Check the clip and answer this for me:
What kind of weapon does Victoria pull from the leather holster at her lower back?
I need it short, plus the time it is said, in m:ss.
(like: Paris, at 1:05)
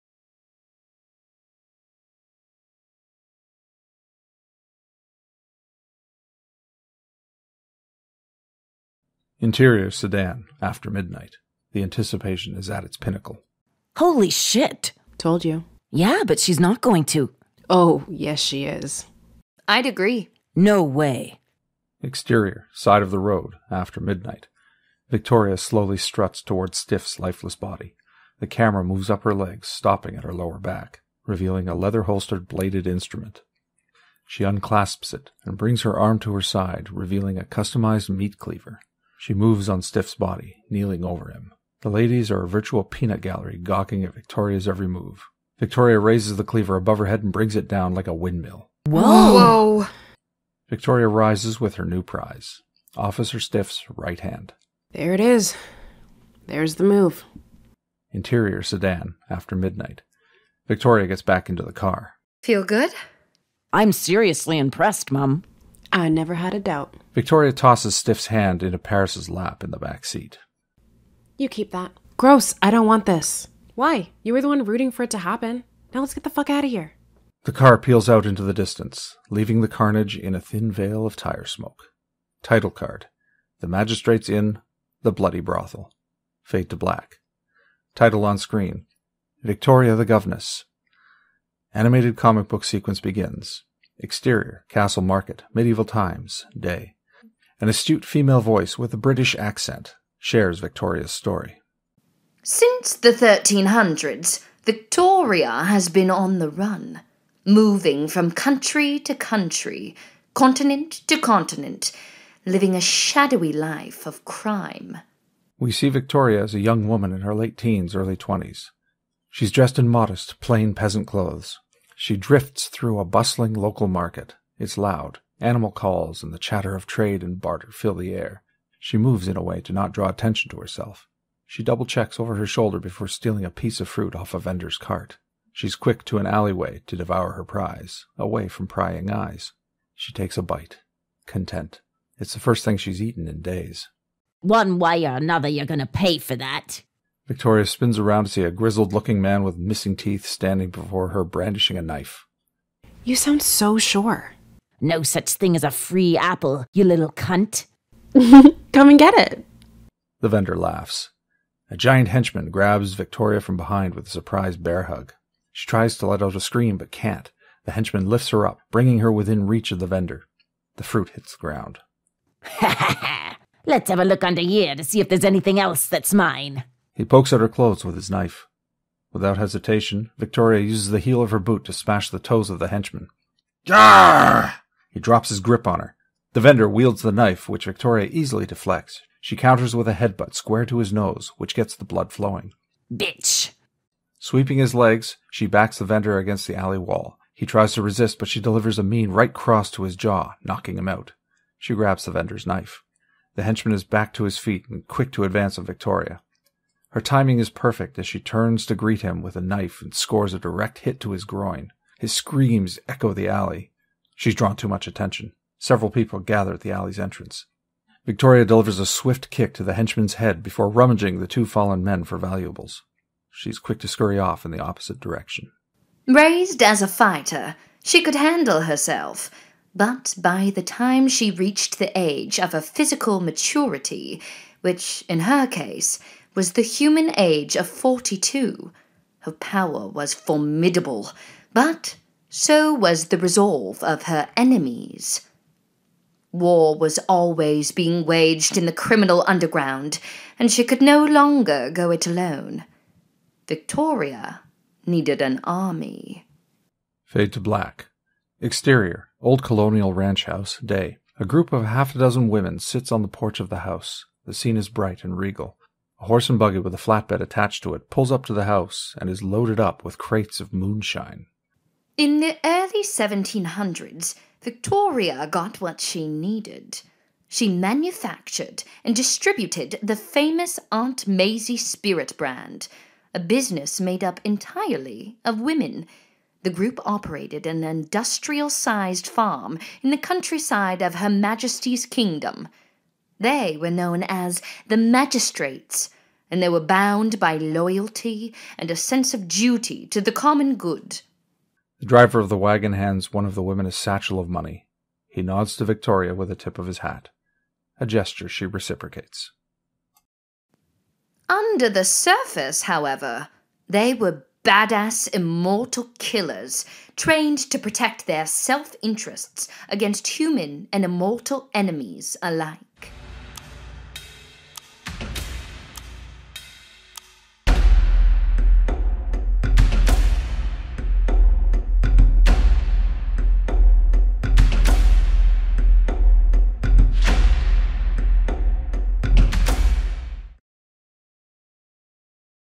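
Meat cleaver, at 0:38.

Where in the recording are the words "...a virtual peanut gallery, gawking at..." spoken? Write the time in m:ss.
0:42.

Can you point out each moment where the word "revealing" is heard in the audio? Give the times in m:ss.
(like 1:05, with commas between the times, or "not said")
0:31, 0:36.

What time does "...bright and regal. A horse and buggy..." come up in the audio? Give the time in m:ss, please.
4:24.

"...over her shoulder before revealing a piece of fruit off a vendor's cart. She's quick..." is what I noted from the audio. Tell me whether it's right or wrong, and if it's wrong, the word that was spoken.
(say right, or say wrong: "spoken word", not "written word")
wrong: "stealing", not "revealing".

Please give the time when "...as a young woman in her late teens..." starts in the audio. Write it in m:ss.
1:56.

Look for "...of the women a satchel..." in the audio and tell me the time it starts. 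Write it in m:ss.
5:03.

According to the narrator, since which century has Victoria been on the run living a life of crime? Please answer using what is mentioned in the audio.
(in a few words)
1300s.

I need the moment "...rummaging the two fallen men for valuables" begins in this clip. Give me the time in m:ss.
3:40.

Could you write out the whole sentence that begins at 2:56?
He pokes at her clothes with his knife.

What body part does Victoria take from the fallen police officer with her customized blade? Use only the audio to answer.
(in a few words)
Right hand.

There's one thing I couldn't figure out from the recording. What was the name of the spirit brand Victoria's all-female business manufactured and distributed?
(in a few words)
Aunt Maisie.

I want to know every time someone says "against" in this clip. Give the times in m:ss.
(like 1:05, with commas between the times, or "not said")
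3:16, 5:19.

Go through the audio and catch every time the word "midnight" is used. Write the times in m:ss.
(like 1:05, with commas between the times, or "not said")
0:10, 0:23, 0:59.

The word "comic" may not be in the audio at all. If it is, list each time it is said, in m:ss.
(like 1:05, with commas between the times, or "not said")
1:32.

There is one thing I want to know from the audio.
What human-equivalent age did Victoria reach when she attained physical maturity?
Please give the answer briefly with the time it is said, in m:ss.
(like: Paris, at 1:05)
42, at 3:57.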